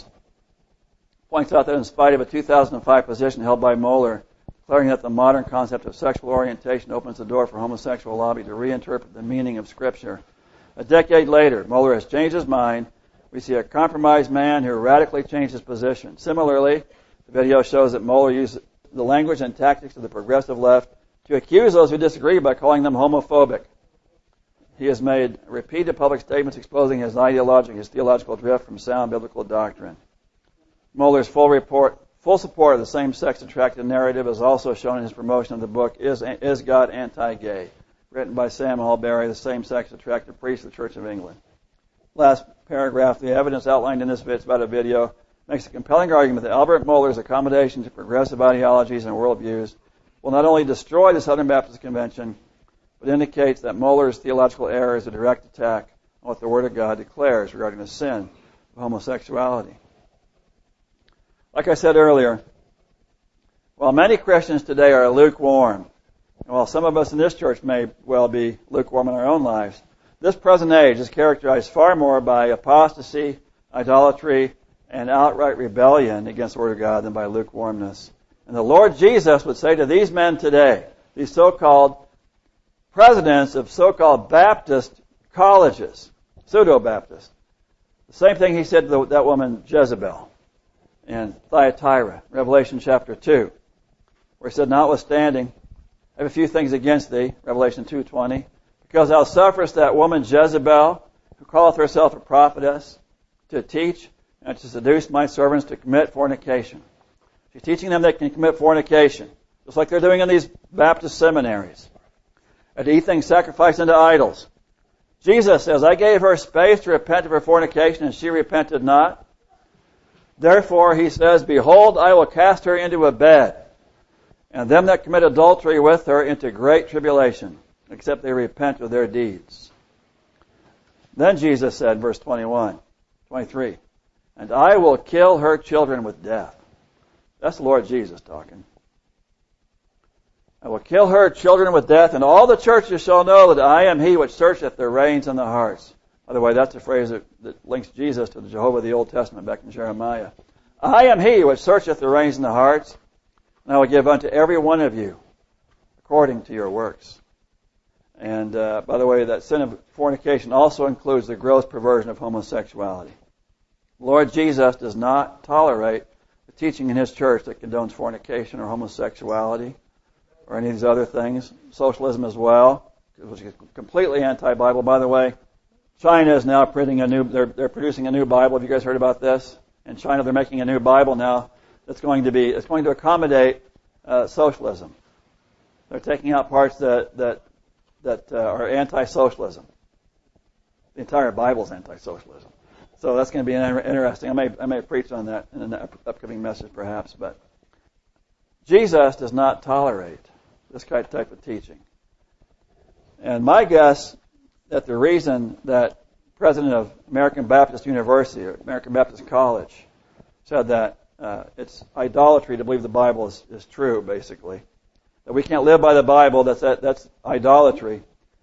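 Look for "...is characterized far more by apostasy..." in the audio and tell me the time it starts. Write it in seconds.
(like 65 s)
70 s.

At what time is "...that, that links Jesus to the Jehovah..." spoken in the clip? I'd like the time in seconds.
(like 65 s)
147 s.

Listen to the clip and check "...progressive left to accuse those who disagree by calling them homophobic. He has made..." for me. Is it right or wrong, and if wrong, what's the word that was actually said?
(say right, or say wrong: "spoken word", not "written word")
right.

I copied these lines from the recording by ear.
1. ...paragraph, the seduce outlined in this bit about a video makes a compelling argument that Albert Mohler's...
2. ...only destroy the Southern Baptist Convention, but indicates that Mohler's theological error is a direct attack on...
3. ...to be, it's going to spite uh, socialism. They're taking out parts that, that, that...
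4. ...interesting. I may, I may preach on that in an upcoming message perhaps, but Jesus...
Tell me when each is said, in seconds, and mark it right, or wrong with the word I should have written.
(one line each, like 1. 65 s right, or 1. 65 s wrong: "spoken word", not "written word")
1. 42 s wrong: "evidence", not "seduce"
2. 50 s right
3. 182 s wrong: "accommodate", not "spite"
4. 193 s right.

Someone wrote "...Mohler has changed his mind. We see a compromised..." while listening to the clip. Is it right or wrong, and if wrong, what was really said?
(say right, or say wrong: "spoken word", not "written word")
right.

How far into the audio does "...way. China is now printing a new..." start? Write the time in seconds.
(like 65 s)
175 s.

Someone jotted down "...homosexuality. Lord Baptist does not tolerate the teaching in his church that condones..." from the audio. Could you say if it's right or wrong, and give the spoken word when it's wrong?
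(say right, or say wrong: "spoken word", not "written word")
wrong: "Jesus", not "Baptist".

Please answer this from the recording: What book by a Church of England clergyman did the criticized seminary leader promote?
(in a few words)
Is God Anti-Gay.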